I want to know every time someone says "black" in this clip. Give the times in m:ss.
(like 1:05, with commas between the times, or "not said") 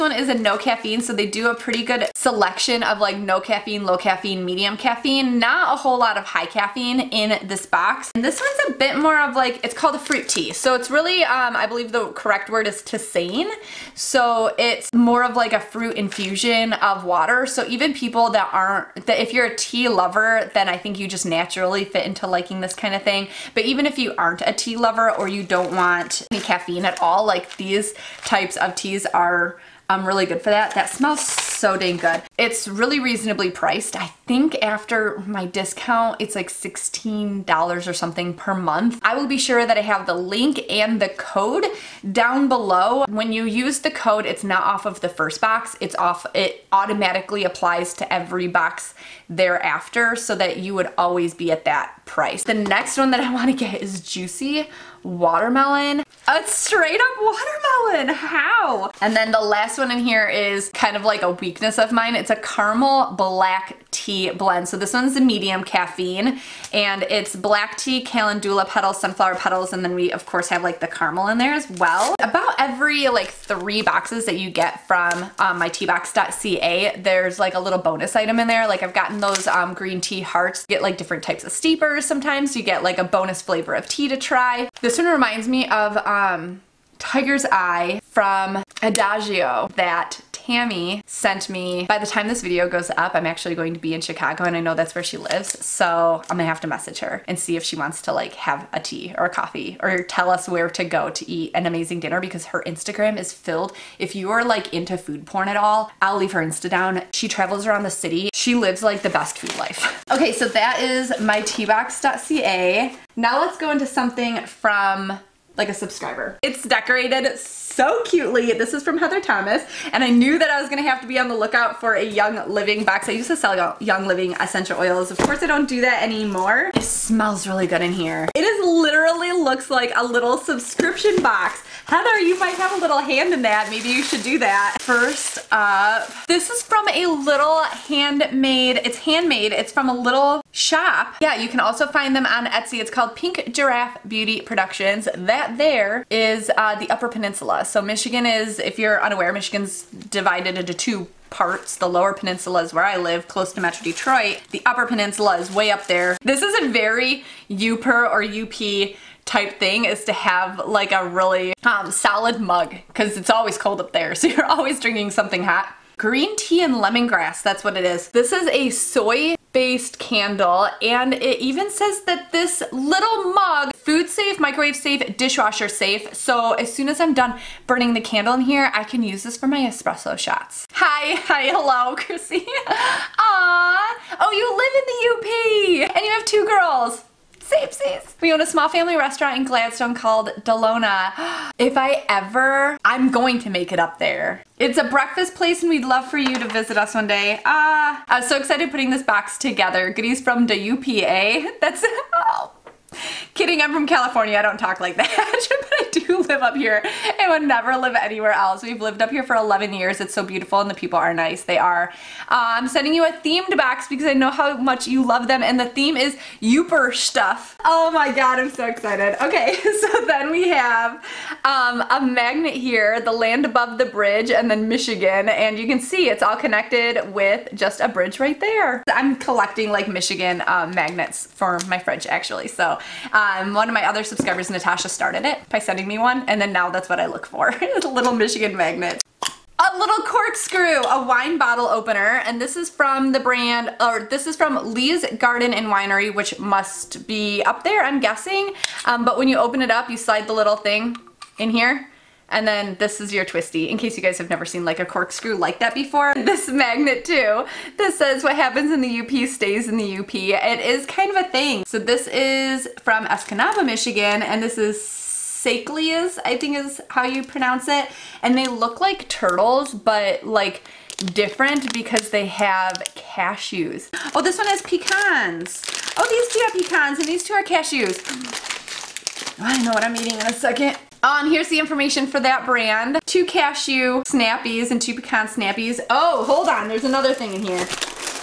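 1:03, 1:07.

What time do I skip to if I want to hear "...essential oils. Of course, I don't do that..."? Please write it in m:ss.
2:04.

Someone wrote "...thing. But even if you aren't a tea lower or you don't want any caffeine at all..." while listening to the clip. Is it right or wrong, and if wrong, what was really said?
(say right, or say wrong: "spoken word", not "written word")
wrong: "lover", not "lower".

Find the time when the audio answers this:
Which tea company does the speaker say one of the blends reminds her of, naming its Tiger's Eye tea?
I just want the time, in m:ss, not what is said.
1:28.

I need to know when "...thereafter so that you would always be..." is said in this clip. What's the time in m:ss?
0:49.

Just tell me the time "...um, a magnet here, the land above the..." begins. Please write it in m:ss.
3:41.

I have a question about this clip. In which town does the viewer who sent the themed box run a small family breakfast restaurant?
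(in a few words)
Gladstone.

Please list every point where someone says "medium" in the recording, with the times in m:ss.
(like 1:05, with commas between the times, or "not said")
0:04, 1:05.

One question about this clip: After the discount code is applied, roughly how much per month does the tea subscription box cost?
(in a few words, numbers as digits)
$16.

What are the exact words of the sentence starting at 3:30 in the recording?
It's so beautiful and the people are nice.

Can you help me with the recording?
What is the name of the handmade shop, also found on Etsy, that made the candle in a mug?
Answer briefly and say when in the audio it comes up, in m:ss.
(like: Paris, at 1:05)
Pink Giraffe Beauty Productions, at 2:23.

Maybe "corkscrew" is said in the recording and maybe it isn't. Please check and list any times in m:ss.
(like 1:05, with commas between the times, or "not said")
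4:00, 4:14.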